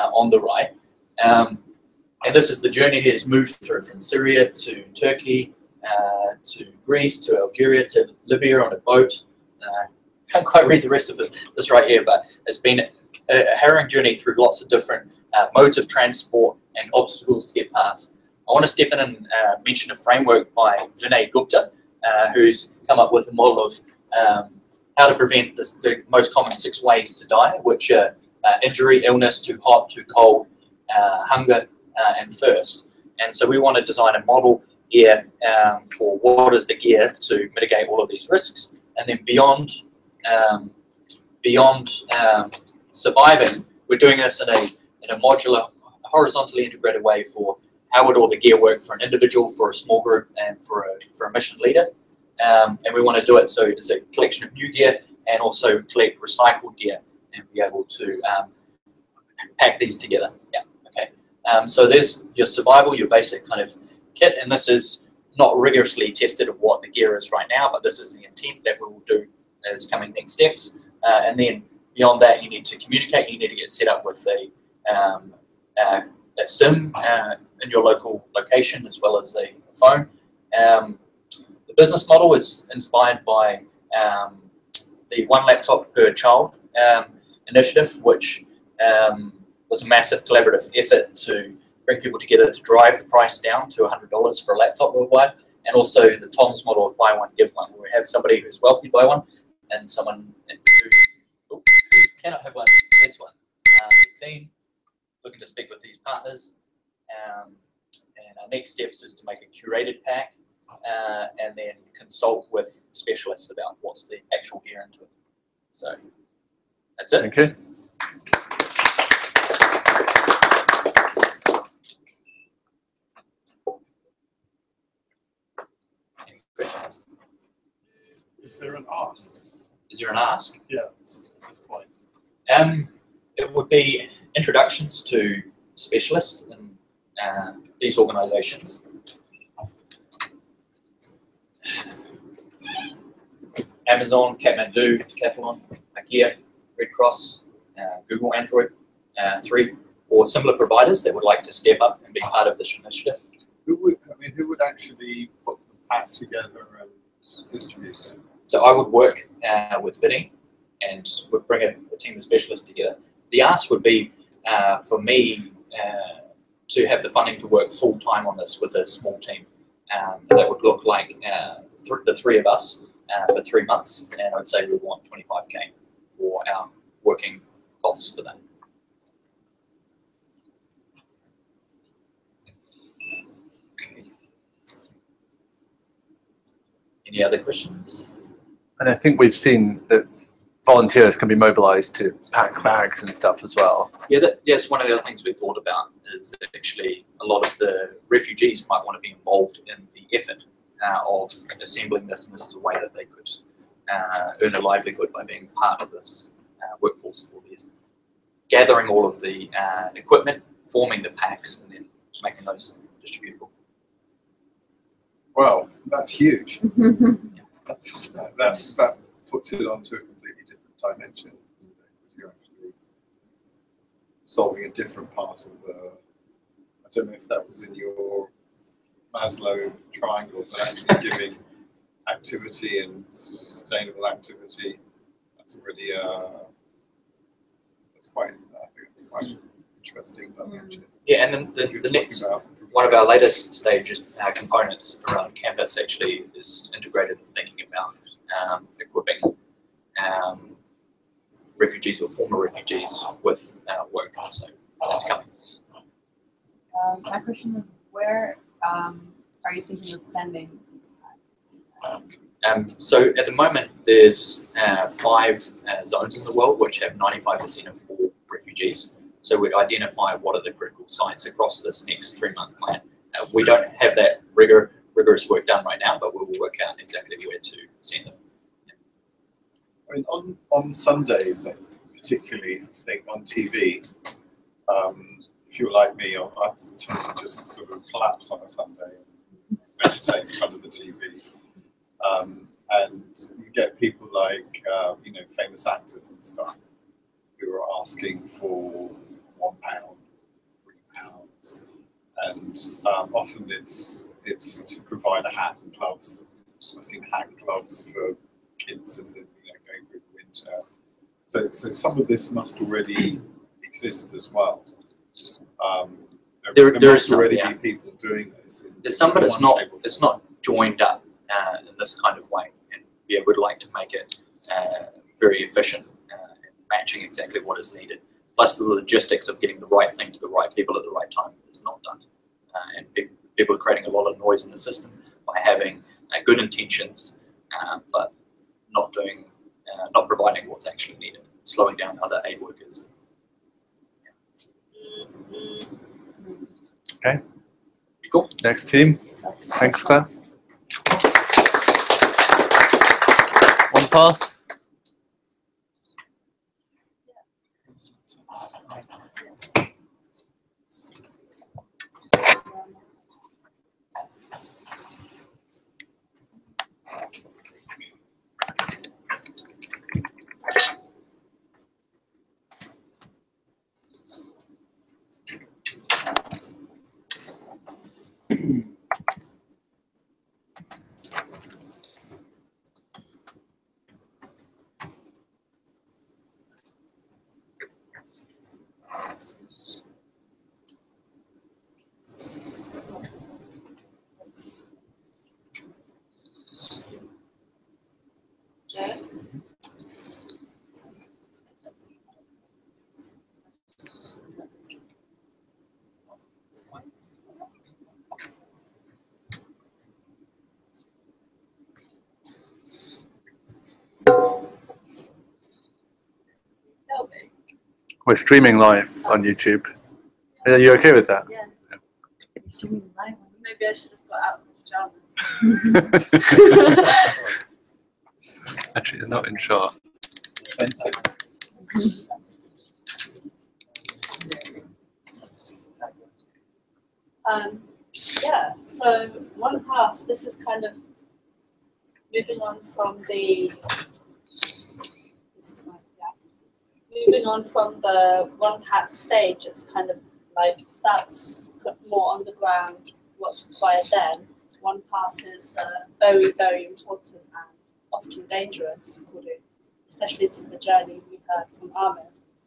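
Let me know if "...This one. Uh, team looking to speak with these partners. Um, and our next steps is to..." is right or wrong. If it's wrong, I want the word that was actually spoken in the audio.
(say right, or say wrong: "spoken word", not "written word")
right.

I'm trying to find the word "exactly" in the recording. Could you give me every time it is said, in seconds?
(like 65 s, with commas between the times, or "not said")
276 s, 327 s.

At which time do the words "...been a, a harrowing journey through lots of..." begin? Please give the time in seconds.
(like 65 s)
12 s.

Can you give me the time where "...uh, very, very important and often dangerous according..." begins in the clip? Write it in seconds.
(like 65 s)
455 s.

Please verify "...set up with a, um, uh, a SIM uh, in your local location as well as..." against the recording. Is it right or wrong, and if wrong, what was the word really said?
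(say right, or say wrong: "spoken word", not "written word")
right.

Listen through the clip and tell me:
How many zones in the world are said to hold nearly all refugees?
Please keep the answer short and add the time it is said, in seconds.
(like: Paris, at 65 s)
5, at 265 s.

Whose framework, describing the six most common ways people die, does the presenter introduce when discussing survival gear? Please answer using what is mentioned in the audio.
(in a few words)
Vinay Gupta.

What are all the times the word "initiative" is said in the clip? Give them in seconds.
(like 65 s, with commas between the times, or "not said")
87 s, 152 s.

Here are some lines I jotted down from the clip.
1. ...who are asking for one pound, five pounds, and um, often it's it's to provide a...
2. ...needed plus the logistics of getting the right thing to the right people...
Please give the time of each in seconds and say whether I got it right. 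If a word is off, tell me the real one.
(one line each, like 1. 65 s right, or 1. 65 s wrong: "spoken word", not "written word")
1. 297 s wrong: "three", not "five"
2. 327 s right.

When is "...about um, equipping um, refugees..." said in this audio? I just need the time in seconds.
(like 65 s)
247 s.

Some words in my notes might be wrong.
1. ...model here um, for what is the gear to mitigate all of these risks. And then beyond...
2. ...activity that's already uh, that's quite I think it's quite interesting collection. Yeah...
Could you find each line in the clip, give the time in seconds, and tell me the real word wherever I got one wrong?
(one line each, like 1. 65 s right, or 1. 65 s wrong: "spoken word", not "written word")
1. 34 s right
2. 234 s wrong: "dimension", not "collection".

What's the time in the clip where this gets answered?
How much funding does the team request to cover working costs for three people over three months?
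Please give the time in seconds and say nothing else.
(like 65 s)
175 s.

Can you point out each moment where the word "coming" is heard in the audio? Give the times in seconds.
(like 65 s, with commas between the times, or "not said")
69 s, 255 s.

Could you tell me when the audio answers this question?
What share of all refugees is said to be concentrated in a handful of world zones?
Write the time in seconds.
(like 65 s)
266 s.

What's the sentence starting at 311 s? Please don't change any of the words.
So so some of this must already exist as well.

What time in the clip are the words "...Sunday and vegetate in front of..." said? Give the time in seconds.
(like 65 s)
288 s.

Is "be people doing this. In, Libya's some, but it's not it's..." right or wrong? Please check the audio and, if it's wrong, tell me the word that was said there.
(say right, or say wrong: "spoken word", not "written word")
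wrong: "There", not "Libya".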